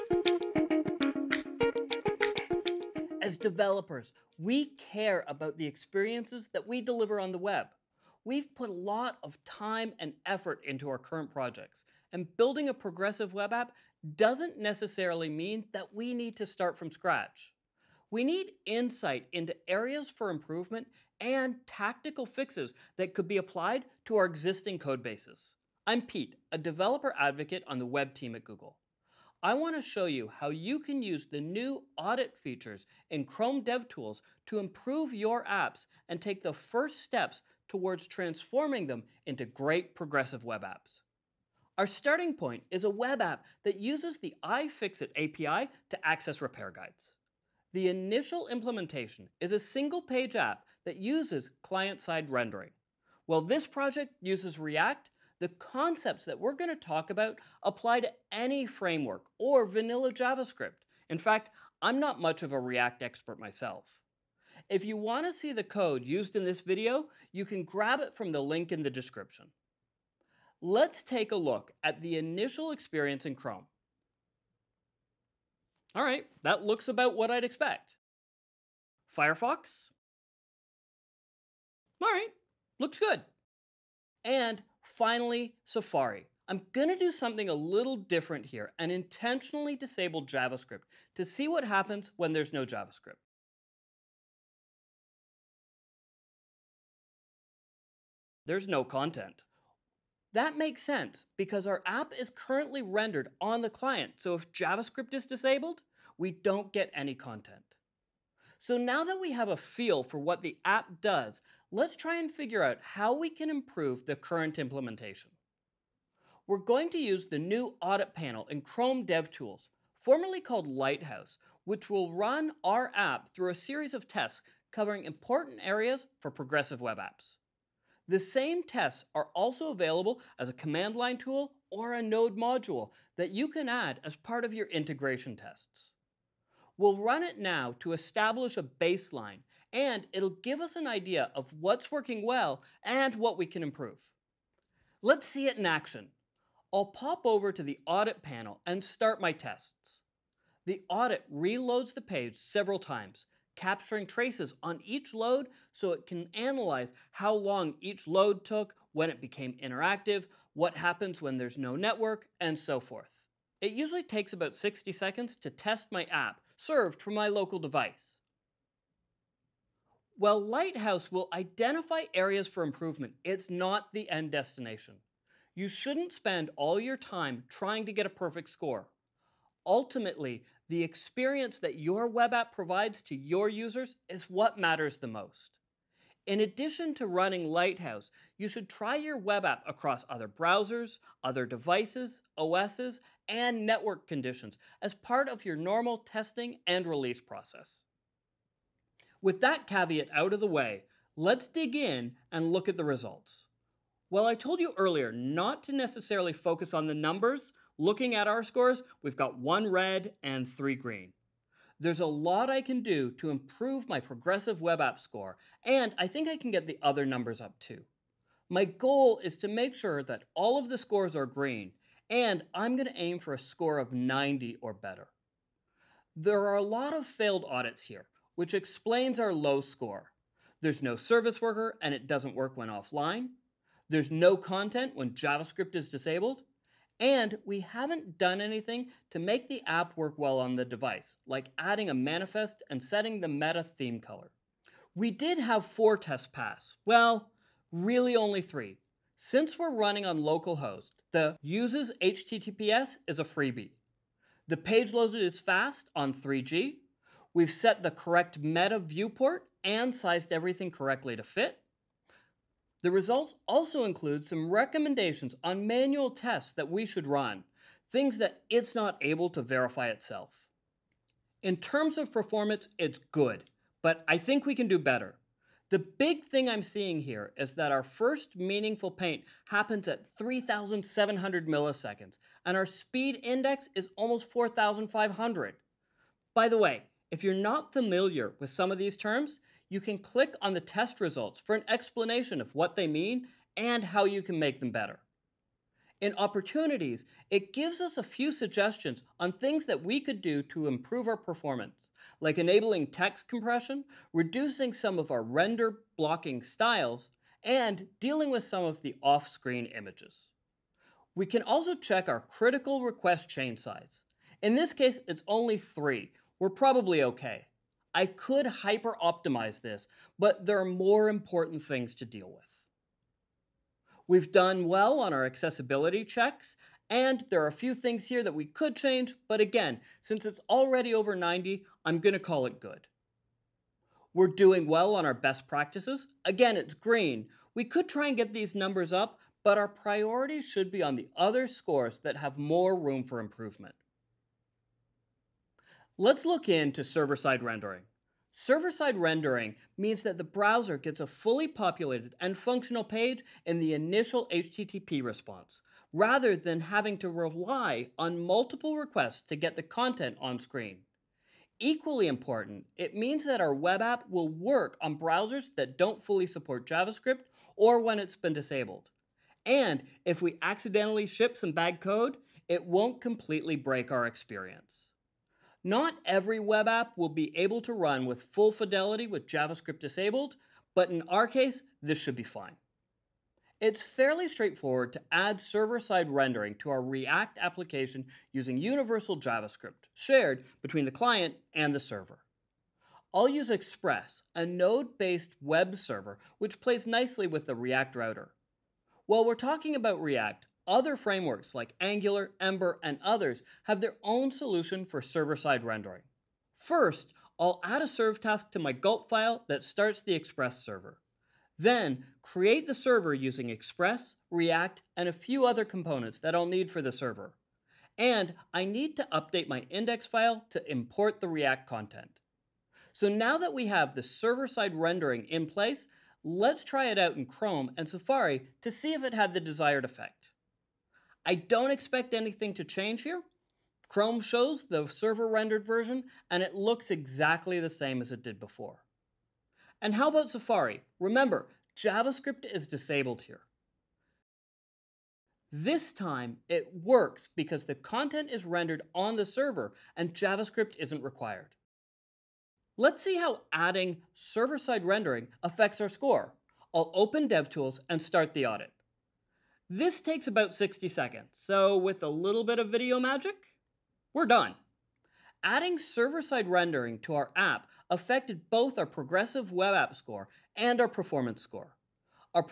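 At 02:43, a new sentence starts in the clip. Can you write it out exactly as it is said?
It usually takes about 60 seconds to test my app served from my local device.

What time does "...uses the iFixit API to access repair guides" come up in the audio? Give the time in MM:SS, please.
00:43.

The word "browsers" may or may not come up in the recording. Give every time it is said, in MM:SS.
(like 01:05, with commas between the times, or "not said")
03:10, 05:50, 06:04.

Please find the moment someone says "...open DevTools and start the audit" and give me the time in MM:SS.
07:36.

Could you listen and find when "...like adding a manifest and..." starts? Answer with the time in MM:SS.
04:01.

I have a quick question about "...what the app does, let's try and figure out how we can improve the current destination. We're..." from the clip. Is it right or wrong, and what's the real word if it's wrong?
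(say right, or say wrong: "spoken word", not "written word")
wrong: "implementation", not "destination".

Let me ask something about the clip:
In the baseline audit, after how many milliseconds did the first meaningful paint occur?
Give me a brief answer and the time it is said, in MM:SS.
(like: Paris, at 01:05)
3,700, at 04:40.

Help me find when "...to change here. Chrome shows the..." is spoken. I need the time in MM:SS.
07:12.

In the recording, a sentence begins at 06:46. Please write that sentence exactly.
First, I'll add a serve task to my gulp file that starts the Express server.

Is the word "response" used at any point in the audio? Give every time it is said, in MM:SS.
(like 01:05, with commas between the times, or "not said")
05:55.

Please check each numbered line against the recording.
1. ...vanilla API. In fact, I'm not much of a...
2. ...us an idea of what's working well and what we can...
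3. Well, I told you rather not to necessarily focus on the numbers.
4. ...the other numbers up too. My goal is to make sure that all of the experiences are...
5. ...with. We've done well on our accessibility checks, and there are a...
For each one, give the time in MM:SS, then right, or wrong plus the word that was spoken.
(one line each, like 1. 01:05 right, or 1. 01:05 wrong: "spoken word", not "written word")
1. 00:59 wrong: "JavaScript", not "API"
2. 02:20 right
3. 03:24 wrong: "earlier", not "rather"
4. 03:36 wrong: "scores", not "experiences"
5. 05:22 right.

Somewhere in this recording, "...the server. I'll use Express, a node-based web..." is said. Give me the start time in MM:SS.
06:31.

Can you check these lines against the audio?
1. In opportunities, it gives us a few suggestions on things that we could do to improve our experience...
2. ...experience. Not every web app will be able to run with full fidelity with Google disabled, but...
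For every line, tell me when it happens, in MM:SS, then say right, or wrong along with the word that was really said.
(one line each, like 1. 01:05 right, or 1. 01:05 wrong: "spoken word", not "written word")
1. 04:55 wrong: "performance", not "experience"
2. 06:14 wrong: "JavaScript", not "Google".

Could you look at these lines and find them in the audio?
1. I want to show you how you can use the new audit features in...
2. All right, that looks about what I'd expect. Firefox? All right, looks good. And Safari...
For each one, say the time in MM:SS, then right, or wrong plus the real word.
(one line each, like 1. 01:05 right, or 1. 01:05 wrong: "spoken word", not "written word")
1. 00:29 right
2. 01:15 wrong: "Finally", not "Safari".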